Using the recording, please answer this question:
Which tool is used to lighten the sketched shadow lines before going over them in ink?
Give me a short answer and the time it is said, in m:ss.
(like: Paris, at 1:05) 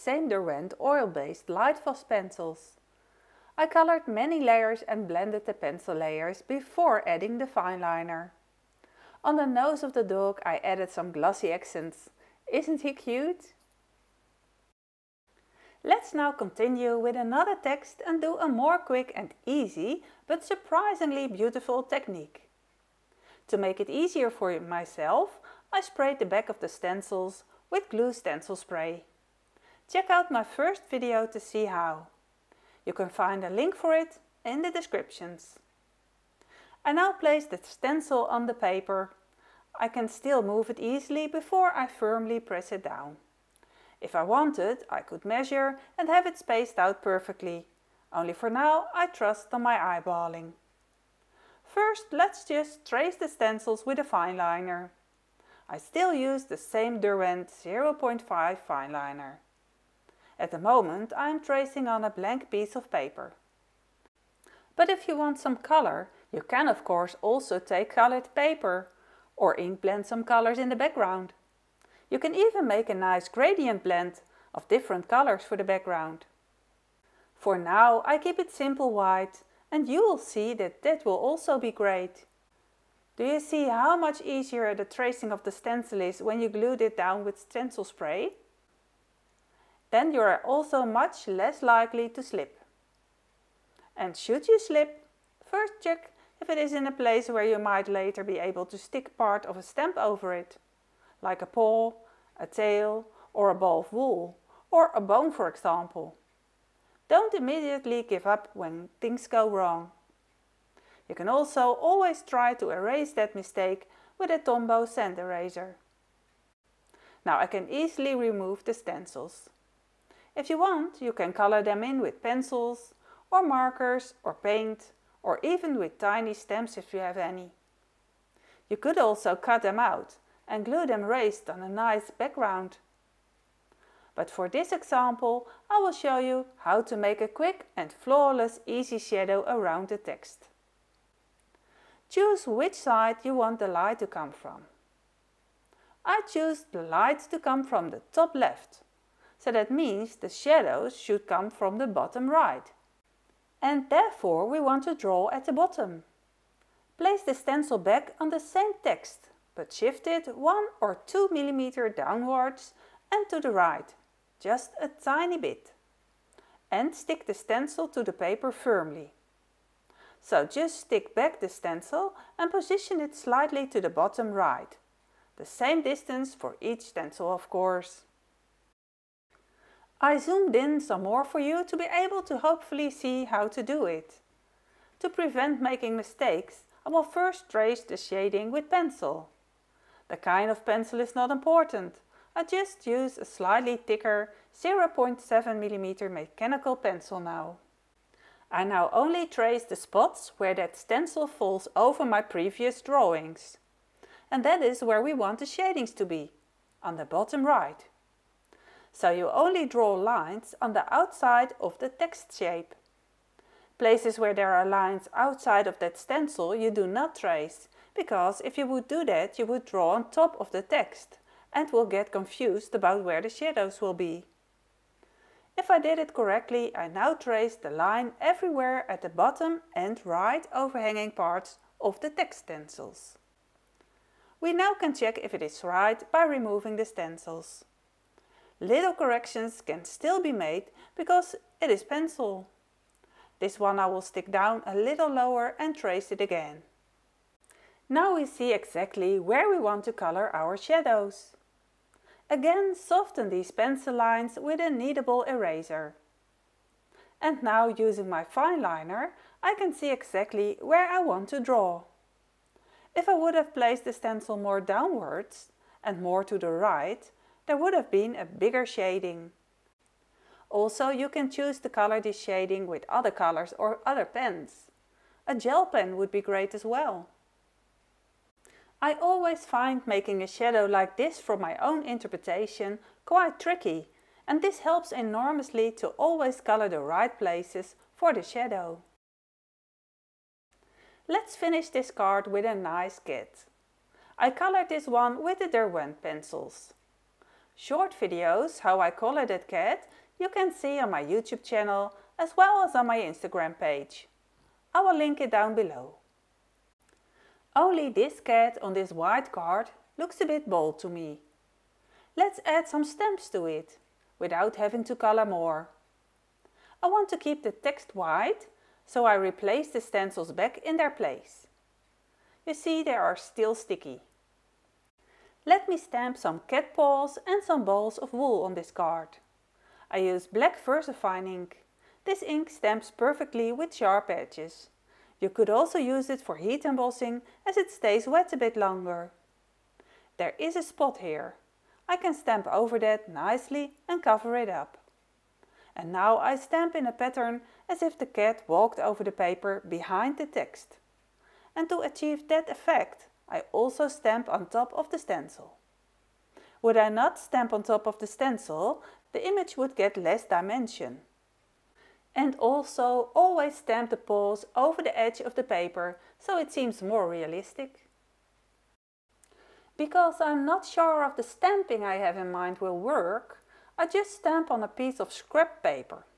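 kneadable eraser, at 4:14.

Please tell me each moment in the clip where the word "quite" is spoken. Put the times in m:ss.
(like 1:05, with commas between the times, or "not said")
4:43.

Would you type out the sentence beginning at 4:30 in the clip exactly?
Also, you can choose to color this shading with other colors or other pens.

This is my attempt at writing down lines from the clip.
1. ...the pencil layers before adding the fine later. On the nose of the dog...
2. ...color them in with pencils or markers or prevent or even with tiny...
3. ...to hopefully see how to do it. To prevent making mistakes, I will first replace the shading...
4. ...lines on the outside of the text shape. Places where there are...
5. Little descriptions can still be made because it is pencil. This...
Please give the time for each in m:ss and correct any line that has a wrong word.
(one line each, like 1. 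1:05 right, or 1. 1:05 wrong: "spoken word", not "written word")
1. 0:05 wrong: "liner", not "later"
2. 2:01 wrong: "paint", not "prevent"
3. 3:02 wrong: "trace", not "replace"
4. 3:29 right
5. 3:58 wrong: "corrections", not "descriptions".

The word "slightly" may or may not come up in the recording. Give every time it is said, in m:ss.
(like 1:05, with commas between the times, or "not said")
2:53, 3:13.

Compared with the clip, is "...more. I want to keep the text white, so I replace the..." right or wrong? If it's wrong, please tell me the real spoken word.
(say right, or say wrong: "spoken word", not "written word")
right.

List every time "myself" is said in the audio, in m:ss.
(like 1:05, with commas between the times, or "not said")
0:24.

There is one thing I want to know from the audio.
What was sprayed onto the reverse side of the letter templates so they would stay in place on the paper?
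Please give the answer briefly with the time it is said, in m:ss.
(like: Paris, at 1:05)
glue stencil spray, at 0:27.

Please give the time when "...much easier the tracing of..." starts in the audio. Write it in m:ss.
1:23.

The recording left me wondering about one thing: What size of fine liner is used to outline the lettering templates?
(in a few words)
0.5.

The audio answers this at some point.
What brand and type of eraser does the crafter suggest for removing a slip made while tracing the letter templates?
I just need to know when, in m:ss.
1:54.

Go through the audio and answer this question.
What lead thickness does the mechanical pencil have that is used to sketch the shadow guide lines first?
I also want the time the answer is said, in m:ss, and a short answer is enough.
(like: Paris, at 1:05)
0.7mm, at 3:14.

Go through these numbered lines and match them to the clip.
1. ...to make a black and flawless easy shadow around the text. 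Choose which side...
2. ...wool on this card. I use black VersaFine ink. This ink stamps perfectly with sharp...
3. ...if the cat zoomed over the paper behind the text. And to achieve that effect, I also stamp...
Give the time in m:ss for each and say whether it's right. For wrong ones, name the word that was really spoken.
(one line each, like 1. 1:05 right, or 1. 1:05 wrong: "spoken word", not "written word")
1. 2:16 wrong: "quick", not "black"
2. 5:28 right
3. 5:47 wrong: "walked", not "zoomed".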